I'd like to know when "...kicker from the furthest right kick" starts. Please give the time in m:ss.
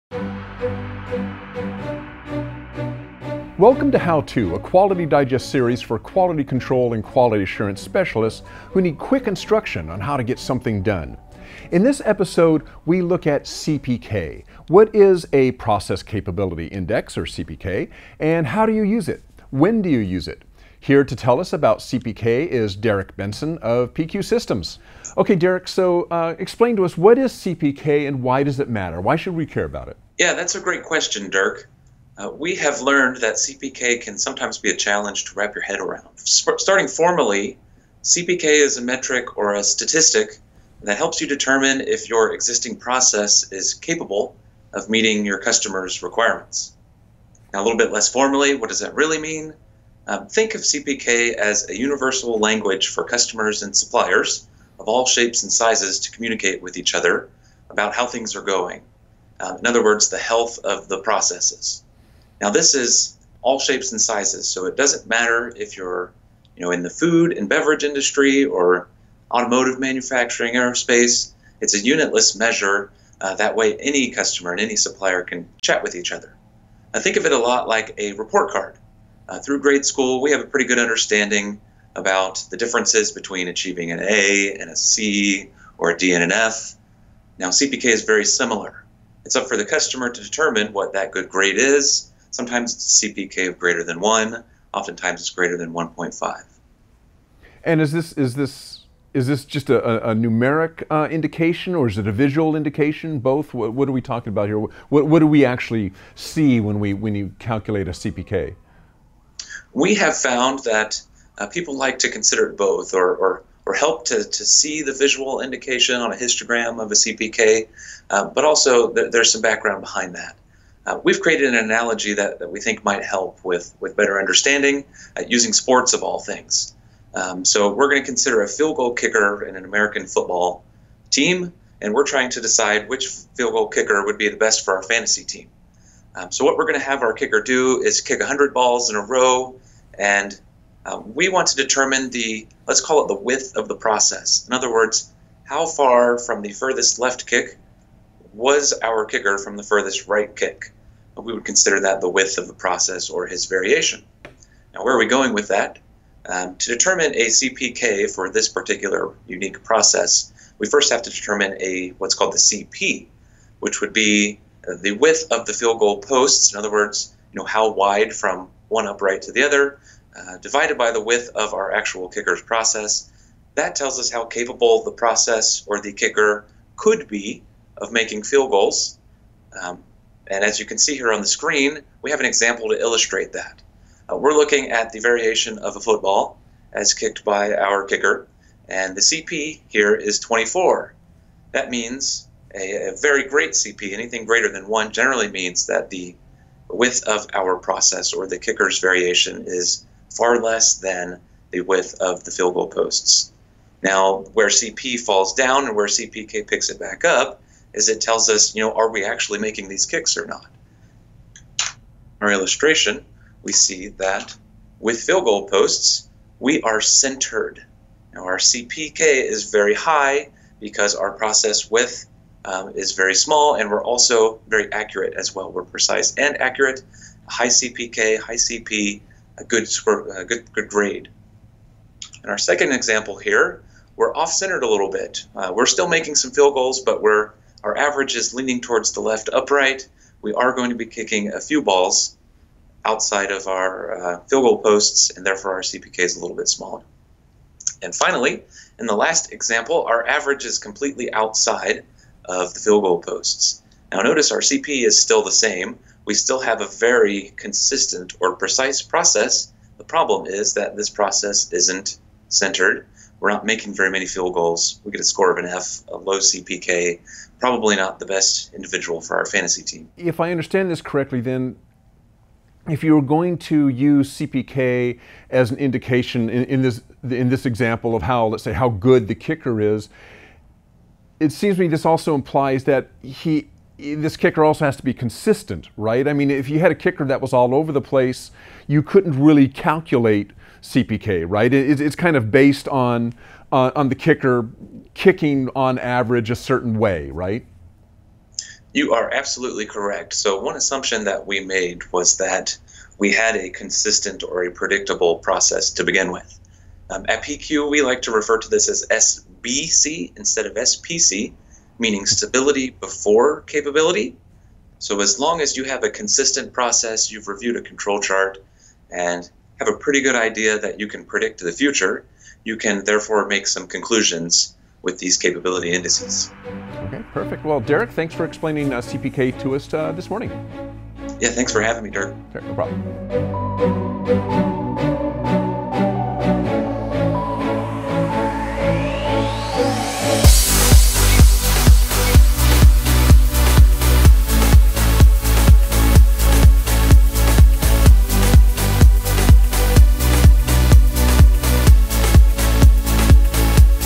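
2:29.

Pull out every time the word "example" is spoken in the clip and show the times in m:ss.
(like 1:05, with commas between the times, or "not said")
3:02, 3:52, 4:09, 4:37.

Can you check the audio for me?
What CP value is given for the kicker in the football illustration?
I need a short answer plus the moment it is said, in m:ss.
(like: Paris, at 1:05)
24, at 3:10.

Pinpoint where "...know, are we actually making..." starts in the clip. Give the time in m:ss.
3:28.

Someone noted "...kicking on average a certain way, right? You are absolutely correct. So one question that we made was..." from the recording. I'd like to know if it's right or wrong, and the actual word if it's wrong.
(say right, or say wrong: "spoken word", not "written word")
wrong: "assumption", not "question".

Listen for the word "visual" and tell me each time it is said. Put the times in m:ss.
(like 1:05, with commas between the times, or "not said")
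1:42, 1:54.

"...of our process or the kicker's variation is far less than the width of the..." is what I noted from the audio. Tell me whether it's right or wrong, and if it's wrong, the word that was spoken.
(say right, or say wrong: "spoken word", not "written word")
right.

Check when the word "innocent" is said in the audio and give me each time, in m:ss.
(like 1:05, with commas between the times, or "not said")
not said.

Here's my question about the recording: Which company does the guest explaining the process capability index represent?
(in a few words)
PQ Systems.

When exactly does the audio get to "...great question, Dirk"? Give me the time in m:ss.
0:30.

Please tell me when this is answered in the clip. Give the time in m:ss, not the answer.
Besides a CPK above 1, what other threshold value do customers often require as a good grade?
1:35.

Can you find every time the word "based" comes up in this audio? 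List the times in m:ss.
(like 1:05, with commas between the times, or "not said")
4:52.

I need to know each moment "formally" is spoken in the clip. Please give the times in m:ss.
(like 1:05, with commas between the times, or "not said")
0:36, 0:48.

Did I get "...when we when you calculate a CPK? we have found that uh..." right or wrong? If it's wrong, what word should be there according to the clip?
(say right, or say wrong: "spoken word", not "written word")
right.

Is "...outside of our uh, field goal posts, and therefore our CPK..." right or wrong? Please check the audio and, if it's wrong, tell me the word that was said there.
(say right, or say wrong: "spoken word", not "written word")
right.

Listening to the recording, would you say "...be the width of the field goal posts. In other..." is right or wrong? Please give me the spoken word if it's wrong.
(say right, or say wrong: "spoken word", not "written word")
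right.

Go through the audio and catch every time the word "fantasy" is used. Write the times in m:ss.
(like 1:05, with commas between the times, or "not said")
2:14, 4:29.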